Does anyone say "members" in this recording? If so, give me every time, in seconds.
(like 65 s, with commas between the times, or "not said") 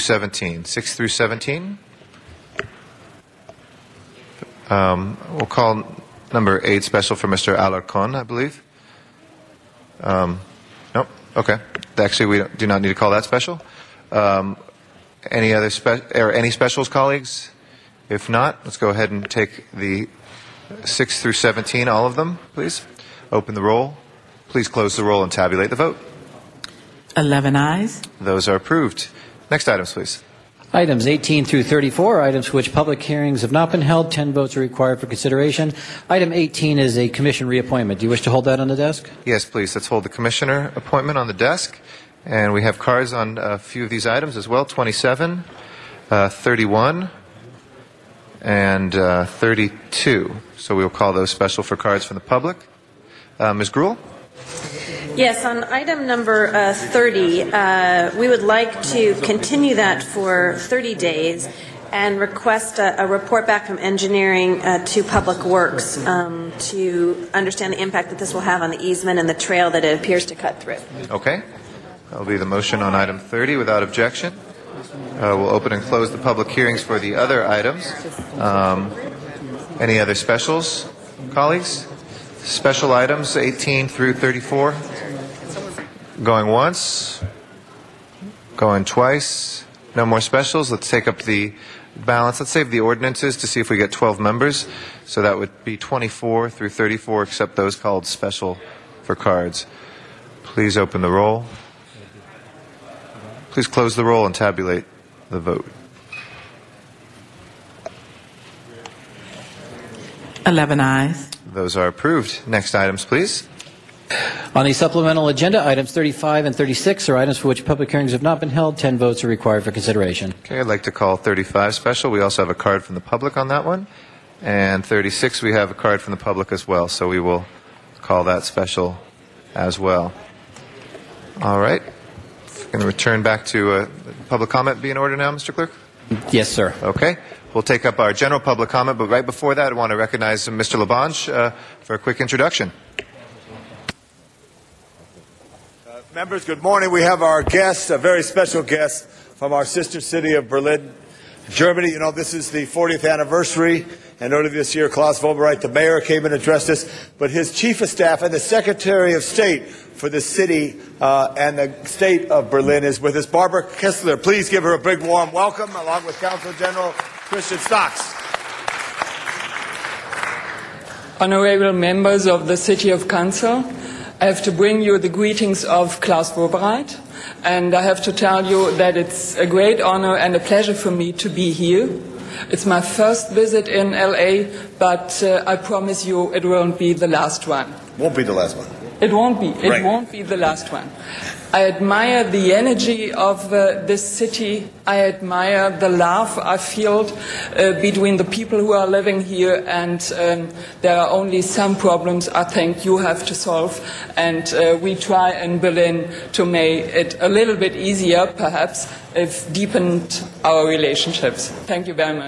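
94 s, 146 s, 171 s.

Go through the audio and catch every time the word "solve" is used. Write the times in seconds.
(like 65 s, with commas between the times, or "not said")
203 s.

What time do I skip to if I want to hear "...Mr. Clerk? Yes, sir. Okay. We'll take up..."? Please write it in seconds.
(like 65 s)
135 s.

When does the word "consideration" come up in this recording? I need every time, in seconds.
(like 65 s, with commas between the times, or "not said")
35 s, 119 s.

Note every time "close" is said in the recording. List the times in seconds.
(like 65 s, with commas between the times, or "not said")
24 s, 75 s, 103 s.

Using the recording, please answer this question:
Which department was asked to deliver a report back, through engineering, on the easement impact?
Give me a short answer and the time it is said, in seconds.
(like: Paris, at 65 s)
Public Works, at 65 s.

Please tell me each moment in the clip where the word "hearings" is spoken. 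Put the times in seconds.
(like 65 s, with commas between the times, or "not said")
33 s, 76 s, 117 s.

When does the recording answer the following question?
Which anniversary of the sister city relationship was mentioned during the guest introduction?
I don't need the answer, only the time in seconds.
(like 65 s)
152 s.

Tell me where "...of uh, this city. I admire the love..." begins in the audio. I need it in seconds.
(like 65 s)
193 s.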